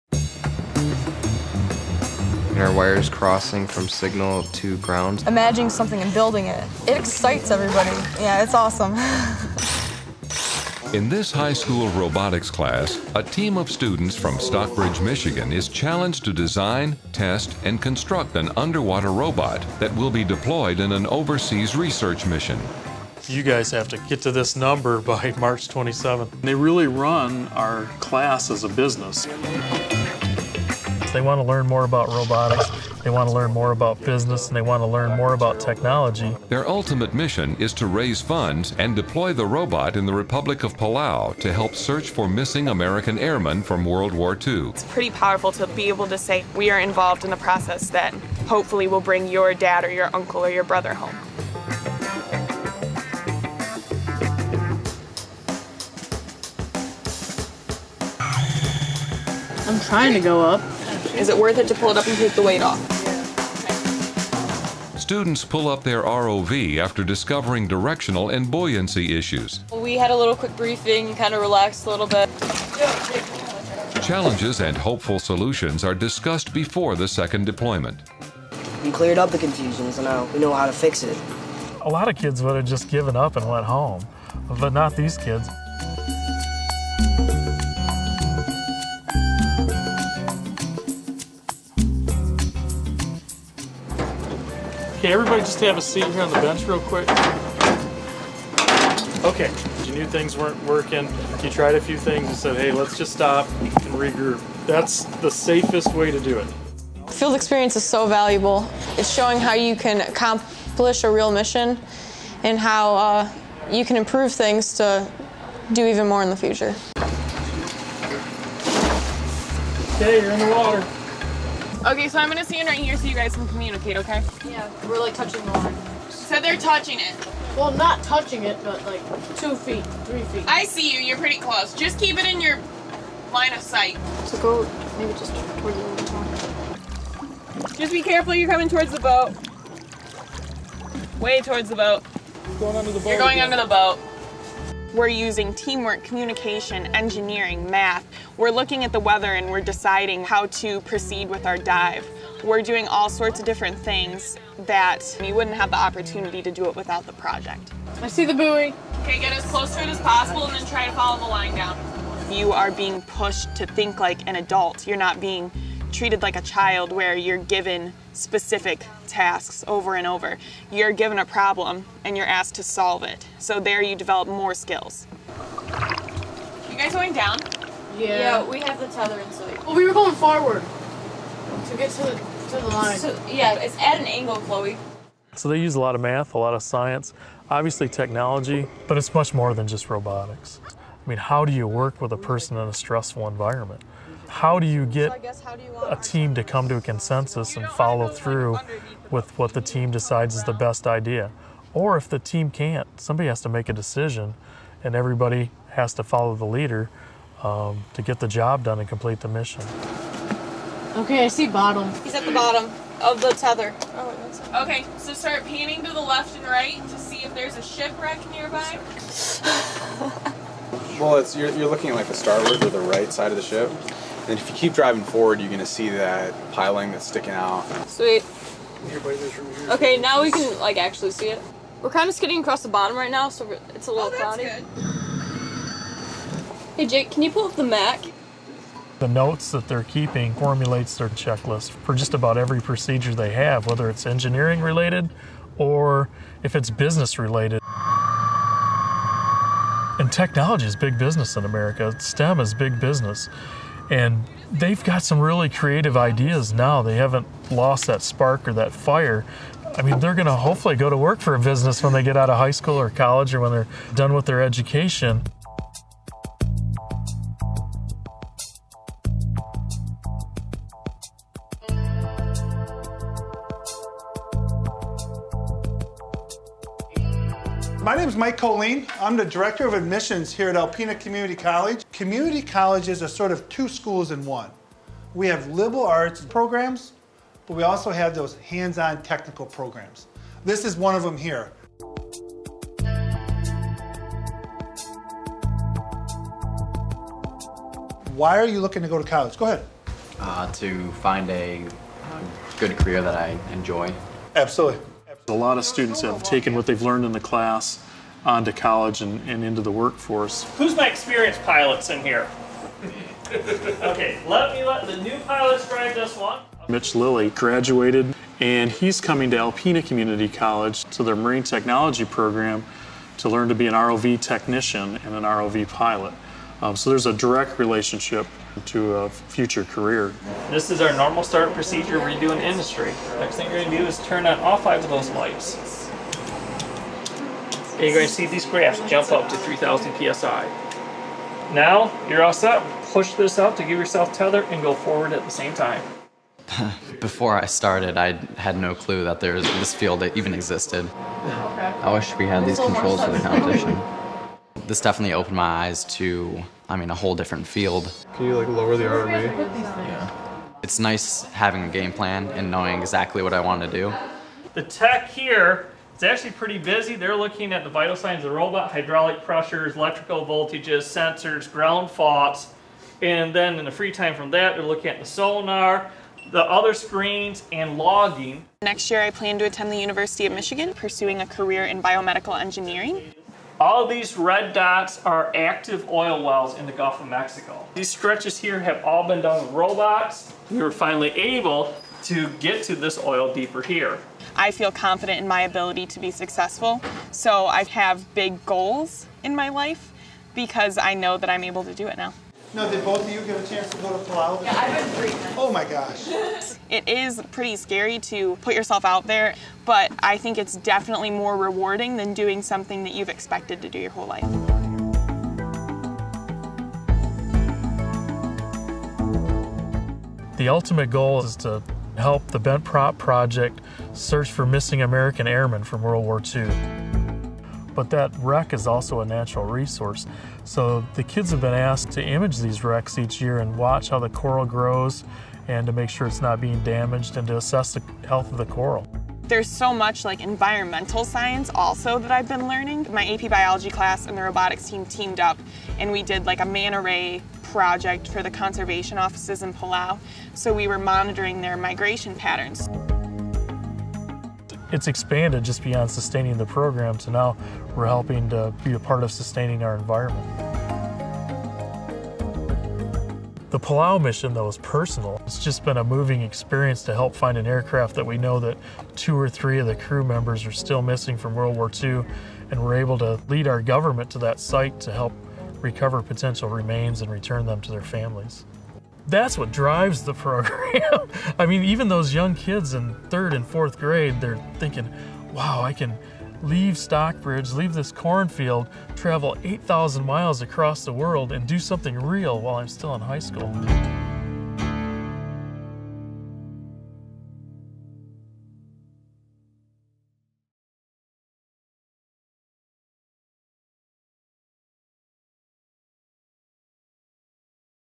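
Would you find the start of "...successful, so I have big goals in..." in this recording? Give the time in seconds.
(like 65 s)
396 s.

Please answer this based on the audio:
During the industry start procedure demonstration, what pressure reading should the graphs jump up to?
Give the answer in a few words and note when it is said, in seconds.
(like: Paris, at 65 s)
3,000 psi, at 339 s.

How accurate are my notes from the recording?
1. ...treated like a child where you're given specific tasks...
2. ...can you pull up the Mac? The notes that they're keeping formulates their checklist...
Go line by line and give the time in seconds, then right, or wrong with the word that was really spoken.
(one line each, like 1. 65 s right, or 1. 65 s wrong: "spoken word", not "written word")
1. 165 s right
2. 237 s right.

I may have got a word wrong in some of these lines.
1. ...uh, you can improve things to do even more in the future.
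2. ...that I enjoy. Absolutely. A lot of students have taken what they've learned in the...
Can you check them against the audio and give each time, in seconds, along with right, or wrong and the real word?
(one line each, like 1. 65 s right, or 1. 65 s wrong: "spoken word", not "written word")
1. 112 s right
2. 303 s right.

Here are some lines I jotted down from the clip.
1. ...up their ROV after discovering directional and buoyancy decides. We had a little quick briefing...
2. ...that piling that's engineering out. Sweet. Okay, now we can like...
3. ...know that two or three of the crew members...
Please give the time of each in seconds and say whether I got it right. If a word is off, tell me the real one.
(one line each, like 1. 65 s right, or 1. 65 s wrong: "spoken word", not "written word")
1. 65 s wrong: "issues", not "decides"
2. 225 s wrong: "sticking", not "engineering"
3. 468 s right.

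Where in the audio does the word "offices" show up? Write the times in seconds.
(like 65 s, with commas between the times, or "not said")
448 s.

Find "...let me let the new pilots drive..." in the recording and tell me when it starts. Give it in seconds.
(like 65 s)
314 s.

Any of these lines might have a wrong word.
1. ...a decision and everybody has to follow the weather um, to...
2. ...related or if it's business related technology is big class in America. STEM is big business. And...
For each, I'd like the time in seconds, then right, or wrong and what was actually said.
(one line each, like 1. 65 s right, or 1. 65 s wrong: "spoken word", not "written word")
1. 203 s wrong: "leader", not "weather"
2. 244 s wrong: "business", not "class".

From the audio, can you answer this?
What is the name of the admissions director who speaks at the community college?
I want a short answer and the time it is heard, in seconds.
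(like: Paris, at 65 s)
Mike Colleen, at 278 s.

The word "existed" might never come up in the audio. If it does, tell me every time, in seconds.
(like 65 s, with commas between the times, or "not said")
350 s.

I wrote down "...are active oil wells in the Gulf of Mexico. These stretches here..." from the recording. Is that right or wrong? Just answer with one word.
right.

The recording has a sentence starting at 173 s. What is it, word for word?
So there you develop more skills.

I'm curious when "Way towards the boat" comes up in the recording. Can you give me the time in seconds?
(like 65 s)
141 s.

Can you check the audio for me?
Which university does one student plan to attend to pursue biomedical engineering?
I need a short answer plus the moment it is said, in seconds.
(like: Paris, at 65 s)
University of Michigan, at 379 s.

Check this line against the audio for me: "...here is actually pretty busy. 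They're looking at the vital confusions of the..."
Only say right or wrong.
wrong.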